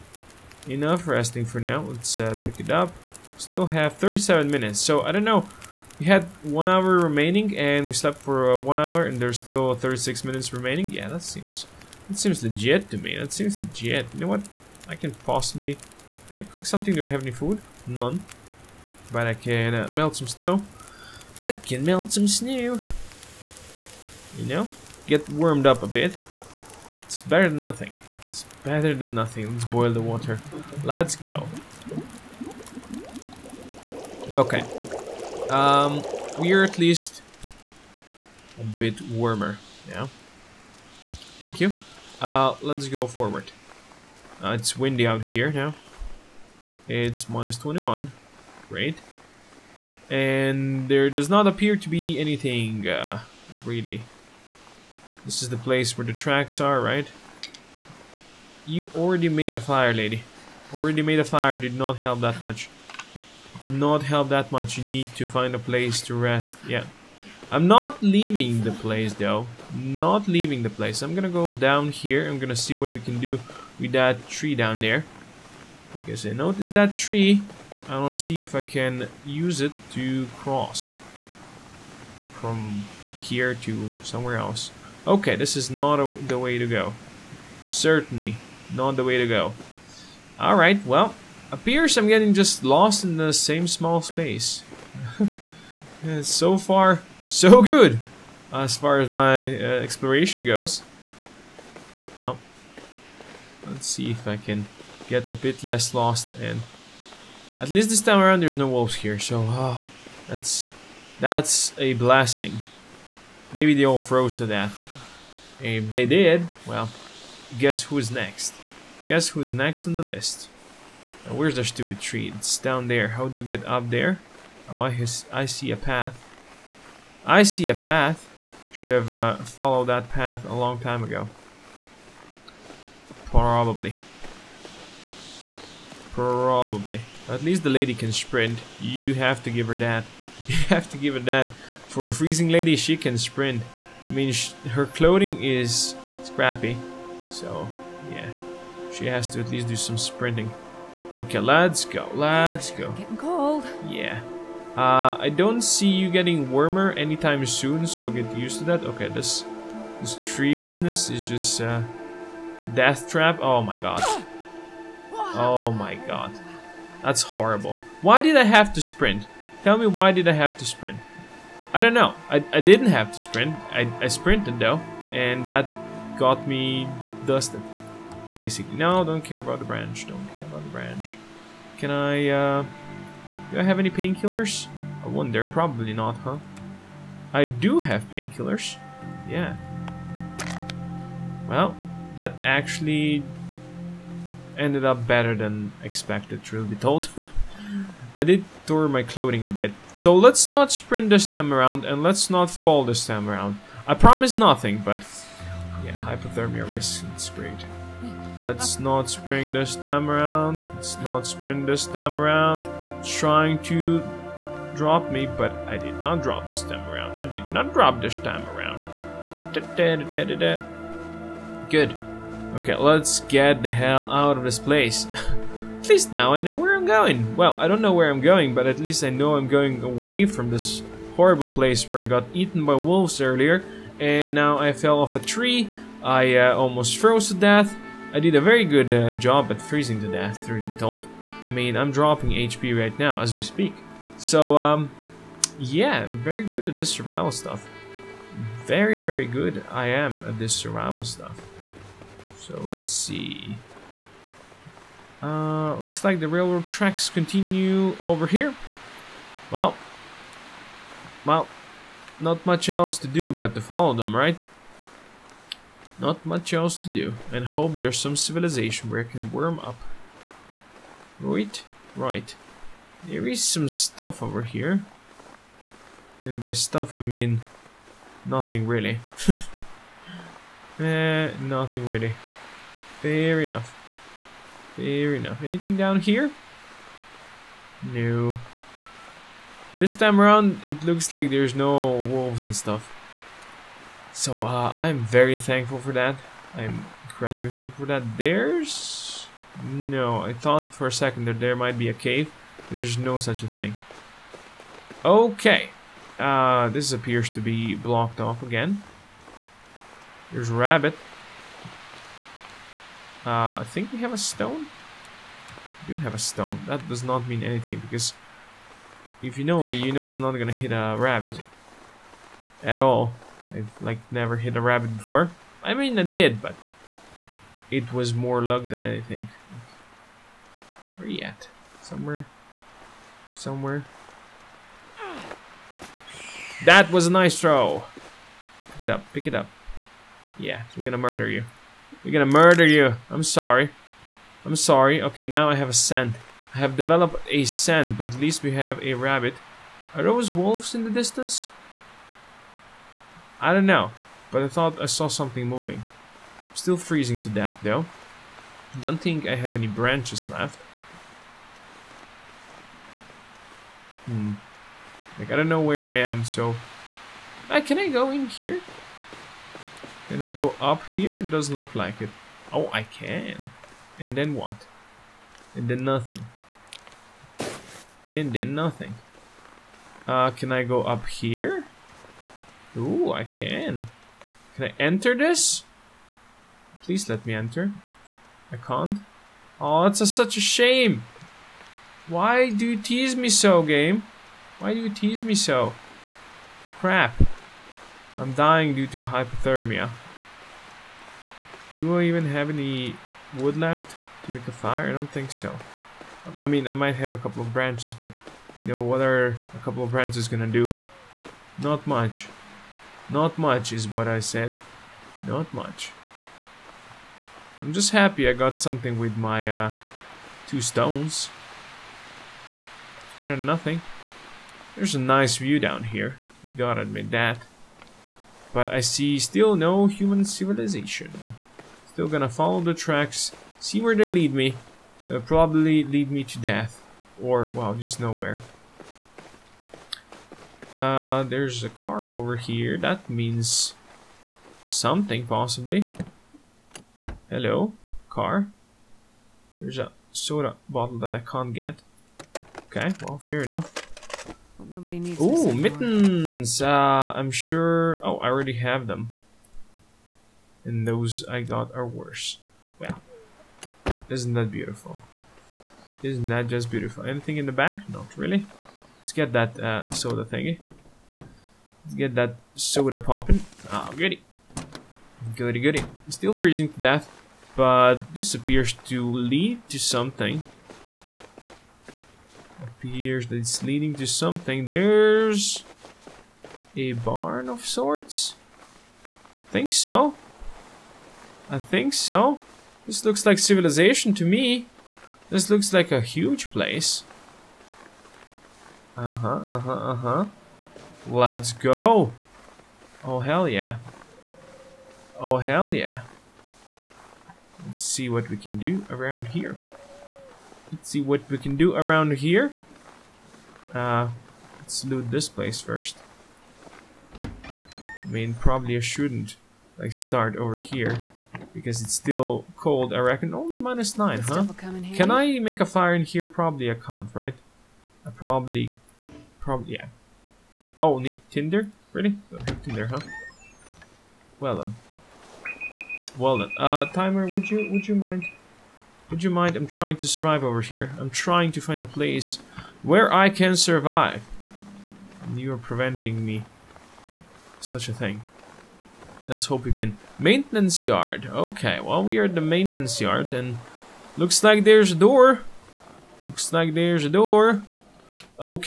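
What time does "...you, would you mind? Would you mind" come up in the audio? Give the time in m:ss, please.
8:57.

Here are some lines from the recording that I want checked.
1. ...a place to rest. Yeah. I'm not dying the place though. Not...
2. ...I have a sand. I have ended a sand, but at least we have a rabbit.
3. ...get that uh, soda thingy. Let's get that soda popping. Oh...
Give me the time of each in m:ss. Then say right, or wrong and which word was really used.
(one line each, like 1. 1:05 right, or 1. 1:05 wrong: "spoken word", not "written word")
1. 1:05 wrong: "leaving", not "dying"
2. 5:45 wrong: "developed", not "ended"
3. 7:49 right.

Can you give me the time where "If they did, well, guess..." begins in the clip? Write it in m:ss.
1:55.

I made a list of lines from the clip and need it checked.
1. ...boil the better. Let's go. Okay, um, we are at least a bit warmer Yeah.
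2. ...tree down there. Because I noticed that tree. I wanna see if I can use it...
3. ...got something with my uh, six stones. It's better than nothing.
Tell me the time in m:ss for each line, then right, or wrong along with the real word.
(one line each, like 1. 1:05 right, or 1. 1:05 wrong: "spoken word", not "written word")
1. 0:29 wrong: "water", not "better"
2. 1:14 right
3. 6:58 wrong: "two", not "six".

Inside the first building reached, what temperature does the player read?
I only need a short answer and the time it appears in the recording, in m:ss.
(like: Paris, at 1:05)
-9, at 8:43.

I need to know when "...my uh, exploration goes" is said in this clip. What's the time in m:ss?
1:39.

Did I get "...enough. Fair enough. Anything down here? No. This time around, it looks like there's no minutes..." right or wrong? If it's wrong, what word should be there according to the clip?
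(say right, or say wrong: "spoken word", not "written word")
wrong: "wolves", not "minutes".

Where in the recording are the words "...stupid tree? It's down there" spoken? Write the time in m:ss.
2:01.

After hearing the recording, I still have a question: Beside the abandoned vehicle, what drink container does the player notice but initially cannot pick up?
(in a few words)
soda bottle.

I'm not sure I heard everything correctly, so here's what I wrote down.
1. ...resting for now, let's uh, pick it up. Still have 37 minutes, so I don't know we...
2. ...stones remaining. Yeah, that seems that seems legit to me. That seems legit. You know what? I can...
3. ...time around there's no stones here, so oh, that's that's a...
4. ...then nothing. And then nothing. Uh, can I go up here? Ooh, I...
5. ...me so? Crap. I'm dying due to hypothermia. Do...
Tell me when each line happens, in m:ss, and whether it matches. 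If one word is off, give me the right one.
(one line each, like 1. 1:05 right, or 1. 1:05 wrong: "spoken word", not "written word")
1. 0:01 right
2. 0:10 wrong: "minutes", not "stones"
3. 1:48 wrong: "wolves", not "stones"
4. 6:15 right
5. 6:35 right.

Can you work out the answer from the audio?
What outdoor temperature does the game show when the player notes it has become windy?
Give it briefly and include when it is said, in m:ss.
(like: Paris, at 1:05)
-21, at 0:47.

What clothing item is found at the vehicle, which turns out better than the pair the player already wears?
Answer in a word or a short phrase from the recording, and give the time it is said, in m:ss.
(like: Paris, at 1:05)
mittens, at 7:35.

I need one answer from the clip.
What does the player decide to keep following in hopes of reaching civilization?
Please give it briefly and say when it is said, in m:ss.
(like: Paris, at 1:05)
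railroad tracks, at 4:16.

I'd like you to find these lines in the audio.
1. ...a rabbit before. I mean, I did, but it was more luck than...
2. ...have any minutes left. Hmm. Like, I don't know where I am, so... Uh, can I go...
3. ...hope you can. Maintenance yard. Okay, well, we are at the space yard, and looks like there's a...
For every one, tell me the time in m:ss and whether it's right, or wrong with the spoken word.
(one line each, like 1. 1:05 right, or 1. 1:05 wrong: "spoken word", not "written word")
1. 5:24 right
2. 5:59 wrong: "branches", not "minutes"
3. 9:09 wrong: "maintenance", not "space".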